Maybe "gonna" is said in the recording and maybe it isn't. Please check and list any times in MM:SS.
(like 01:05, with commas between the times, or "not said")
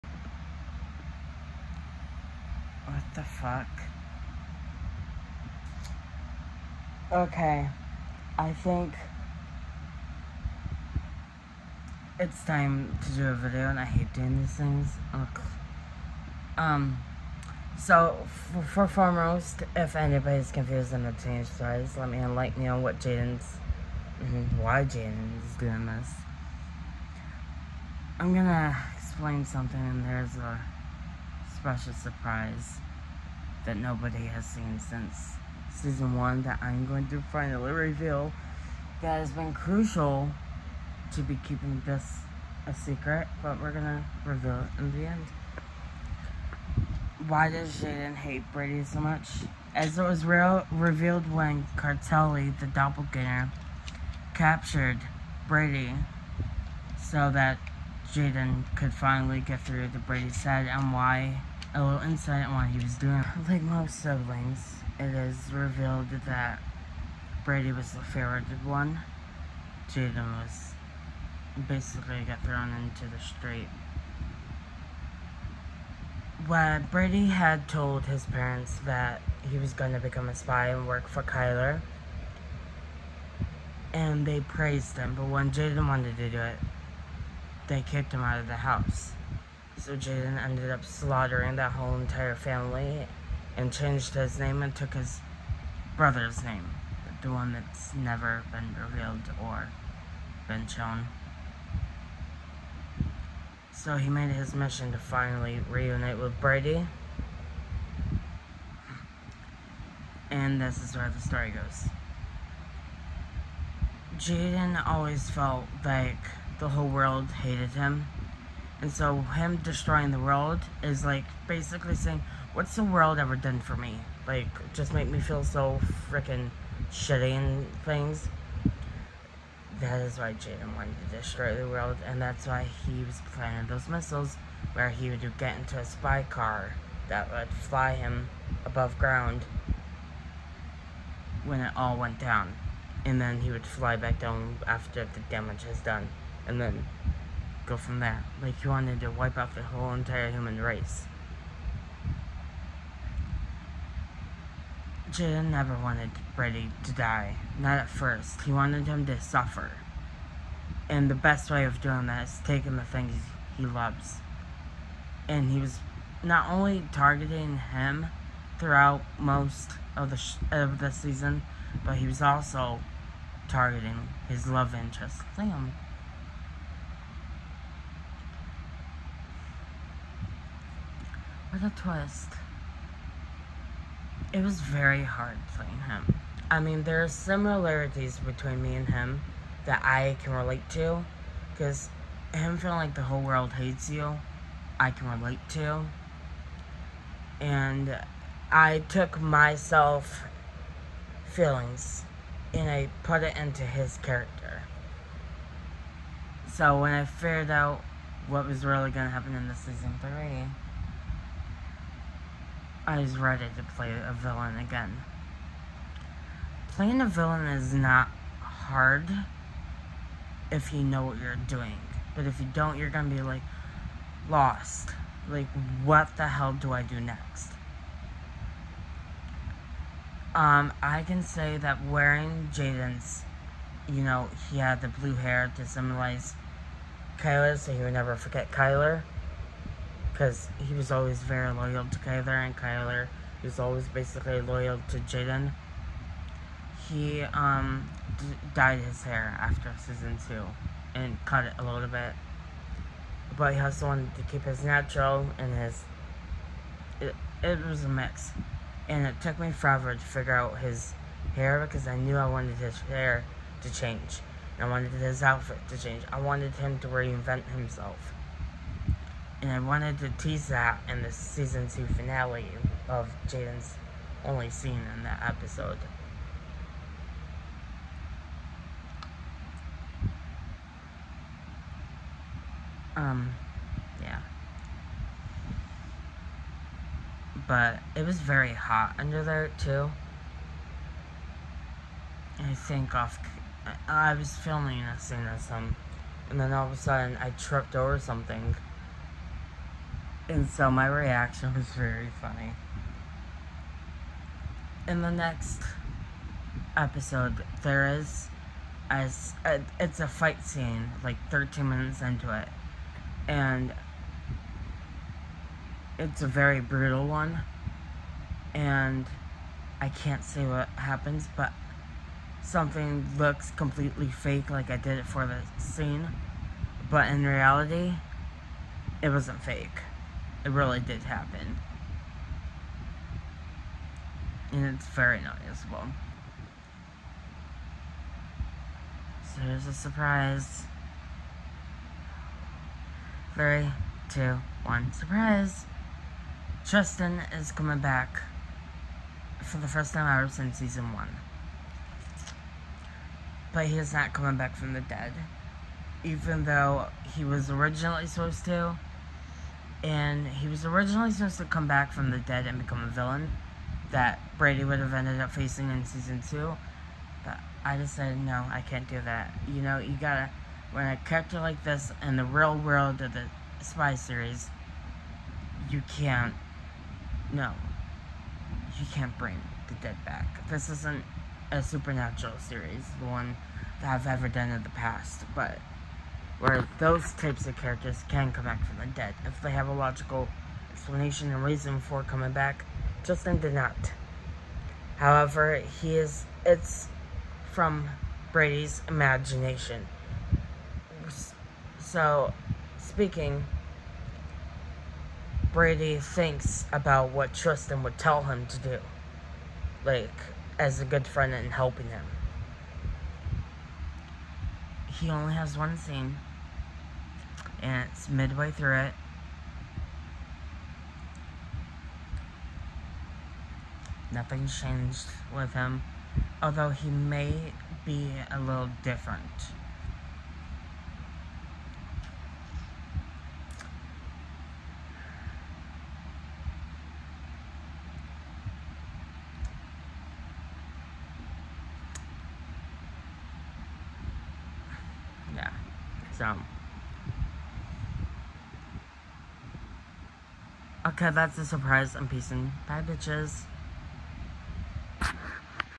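00:28, 00:43.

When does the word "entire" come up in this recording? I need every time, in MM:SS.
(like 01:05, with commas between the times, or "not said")
01:31, 02:29.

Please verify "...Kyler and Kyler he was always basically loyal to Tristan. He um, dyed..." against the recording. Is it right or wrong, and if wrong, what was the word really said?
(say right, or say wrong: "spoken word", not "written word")
wrong: "Jaden", not "Tristan".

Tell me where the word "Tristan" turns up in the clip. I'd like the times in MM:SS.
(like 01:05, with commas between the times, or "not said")
05:46, 06:33, 06:47.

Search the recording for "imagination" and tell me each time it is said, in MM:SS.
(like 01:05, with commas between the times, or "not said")
06:38.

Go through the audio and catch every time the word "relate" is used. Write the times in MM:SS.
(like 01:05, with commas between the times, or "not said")
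03:10, 03:15.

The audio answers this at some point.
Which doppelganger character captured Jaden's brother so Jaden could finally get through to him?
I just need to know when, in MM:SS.
00:51.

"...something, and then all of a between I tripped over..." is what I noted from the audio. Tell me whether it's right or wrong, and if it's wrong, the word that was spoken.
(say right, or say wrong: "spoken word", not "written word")
wrong: "sudden", not "between".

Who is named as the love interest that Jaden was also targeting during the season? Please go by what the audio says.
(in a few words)
Liam.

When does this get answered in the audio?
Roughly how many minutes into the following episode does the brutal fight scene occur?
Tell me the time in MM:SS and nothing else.
05:11.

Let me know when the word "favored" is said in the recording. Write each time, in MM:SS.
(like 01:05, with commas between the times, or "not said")
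01:08.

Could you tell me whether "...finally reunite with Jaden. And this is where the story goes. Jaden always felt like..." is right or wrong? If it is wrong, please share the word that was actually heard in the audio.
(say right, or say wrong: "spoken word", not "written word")
wrong: "Brady", not "Jaden".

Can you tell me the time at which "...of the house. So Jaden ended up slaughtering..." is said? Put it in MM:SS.
01:28.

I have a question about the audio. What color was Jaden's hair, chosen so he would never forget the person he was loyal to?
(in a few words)
Blue.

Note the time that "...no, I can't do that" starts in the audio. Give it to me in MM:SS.
06:08.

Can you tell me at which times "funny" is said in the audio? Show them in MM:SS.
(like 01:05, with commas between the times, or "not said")
05:02.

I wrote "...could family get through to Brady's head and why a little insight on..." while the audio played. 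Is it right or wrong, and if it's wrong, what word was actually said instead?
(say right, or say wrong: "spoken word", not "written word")
wrong: "finally", not "family".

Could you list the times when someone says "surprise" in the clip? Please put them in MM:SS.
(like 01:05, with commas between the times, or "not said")
00:31, 05:39, 05:44, 07:31.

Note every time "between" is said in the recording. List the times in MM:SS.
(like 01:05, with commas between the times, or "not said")
03:08.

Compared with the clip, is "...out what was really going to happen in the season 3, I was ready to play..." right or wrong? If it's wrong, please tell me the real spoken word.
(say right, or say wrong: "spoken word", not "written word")
right.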